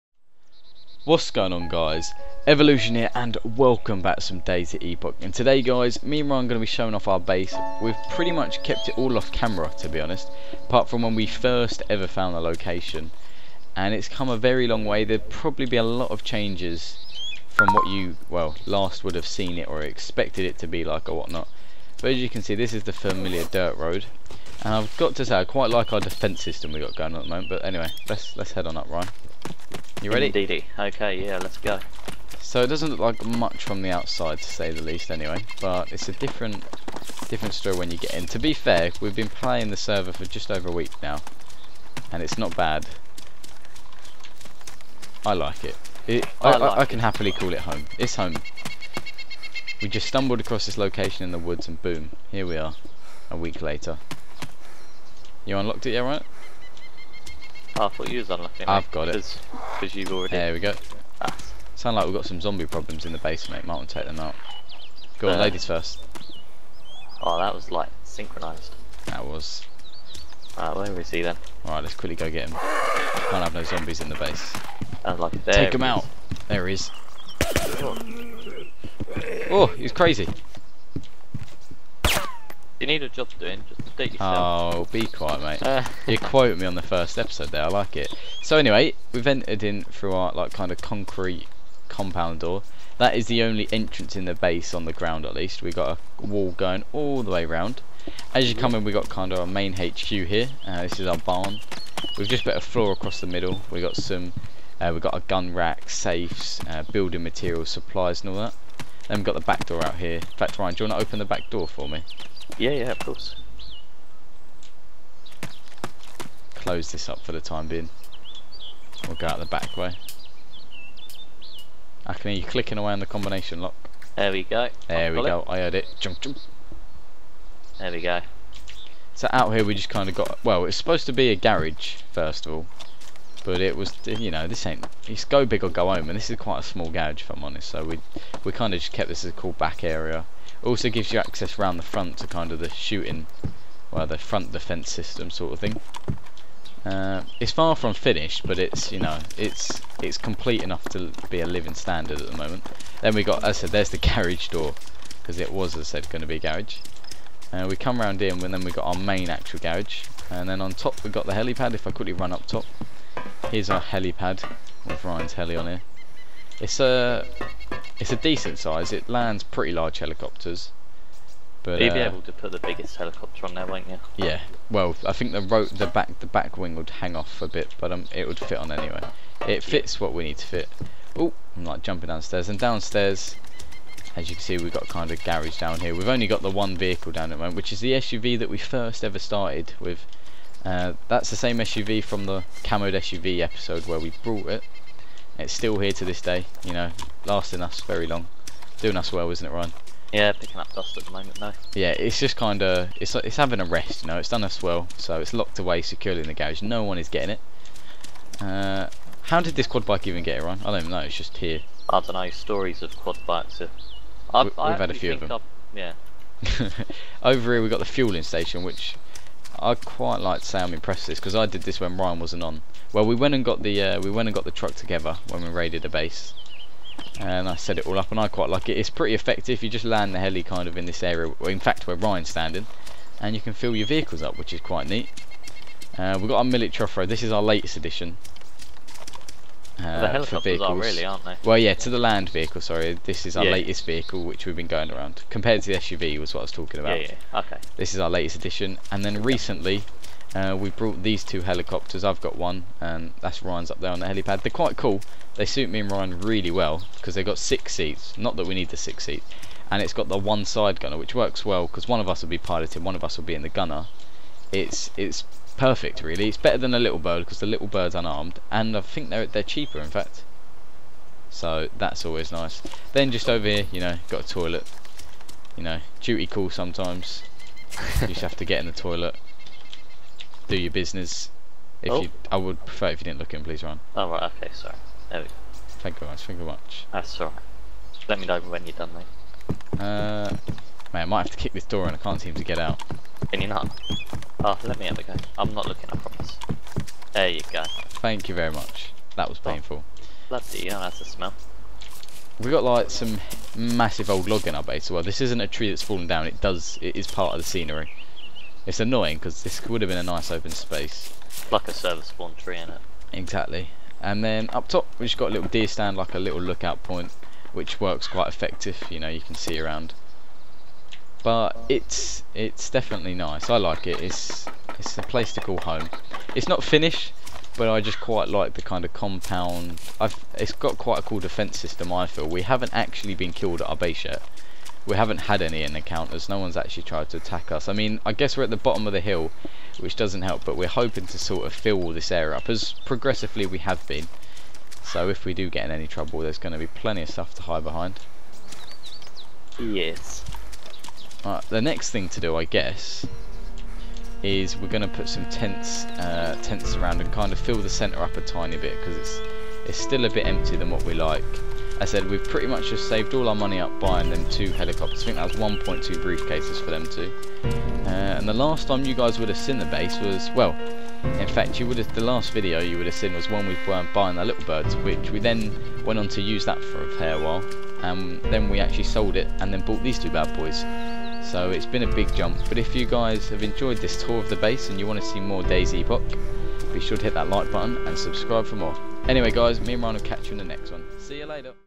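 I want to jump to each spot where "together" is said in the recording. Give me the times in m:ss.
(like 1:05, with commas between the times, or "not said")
3:44.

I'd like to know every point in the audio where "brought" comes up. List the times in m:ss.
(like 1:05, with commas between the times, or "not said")
3:14, 4:10.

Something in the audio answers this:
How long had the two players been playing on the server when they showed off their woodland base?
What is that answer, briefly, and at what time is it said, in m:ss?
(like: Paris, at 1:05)
just over a week, at 0:40.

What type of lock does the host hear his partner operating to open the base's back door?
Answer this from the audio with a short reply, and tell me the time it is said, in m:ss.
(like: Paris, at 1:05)
combination lock, at 2:03.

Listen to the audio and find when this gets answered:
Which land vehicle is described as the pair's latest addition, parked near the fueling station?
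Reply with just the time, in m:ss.
3:56.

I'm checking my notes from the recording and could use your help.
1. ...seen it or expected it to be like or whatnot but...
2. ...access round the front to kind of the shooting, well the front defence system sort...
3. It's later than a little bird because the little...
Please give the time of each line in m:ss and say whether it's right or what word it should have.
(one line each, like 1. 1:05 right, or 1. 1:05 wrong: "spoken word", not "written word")
1. 0:19 right
2. 2:21 right
3. 4:26 wrong: "better", not "later".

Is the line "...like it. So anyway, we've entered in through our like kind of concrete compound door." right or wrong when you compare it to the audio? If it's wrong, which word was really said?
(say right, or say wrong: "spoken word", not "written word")
right.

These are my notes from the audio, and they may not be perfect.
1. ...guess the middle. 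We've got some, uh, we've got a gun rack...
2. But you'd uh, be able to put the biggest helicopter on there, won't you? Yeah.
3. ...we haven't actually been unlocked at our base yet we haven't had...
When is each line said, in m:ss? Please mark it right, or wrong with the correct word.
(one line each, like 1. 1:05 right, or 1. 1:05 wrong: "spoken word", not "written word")
1. 1:42 wrong: "across", not "guess"
2. 2:51 right
3. 5:32 wrong: "killed", not "unlocked".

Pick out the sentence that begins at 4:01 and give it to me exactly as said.
Well, yeah, to the land vehicle.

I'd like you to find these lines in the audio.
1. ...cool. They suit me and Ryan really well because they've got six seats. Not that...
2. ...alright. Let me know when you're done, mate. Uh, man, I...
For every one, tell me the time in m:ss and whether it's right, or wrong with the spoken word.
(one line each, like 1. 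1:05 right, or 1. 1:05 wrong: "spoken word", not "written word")
1. 4:14 right
2. 4:47 right.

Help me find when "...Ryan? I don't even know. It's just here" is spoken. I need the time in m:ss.
3:30.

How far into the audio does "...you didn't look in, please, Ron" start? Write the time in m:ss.
4:42.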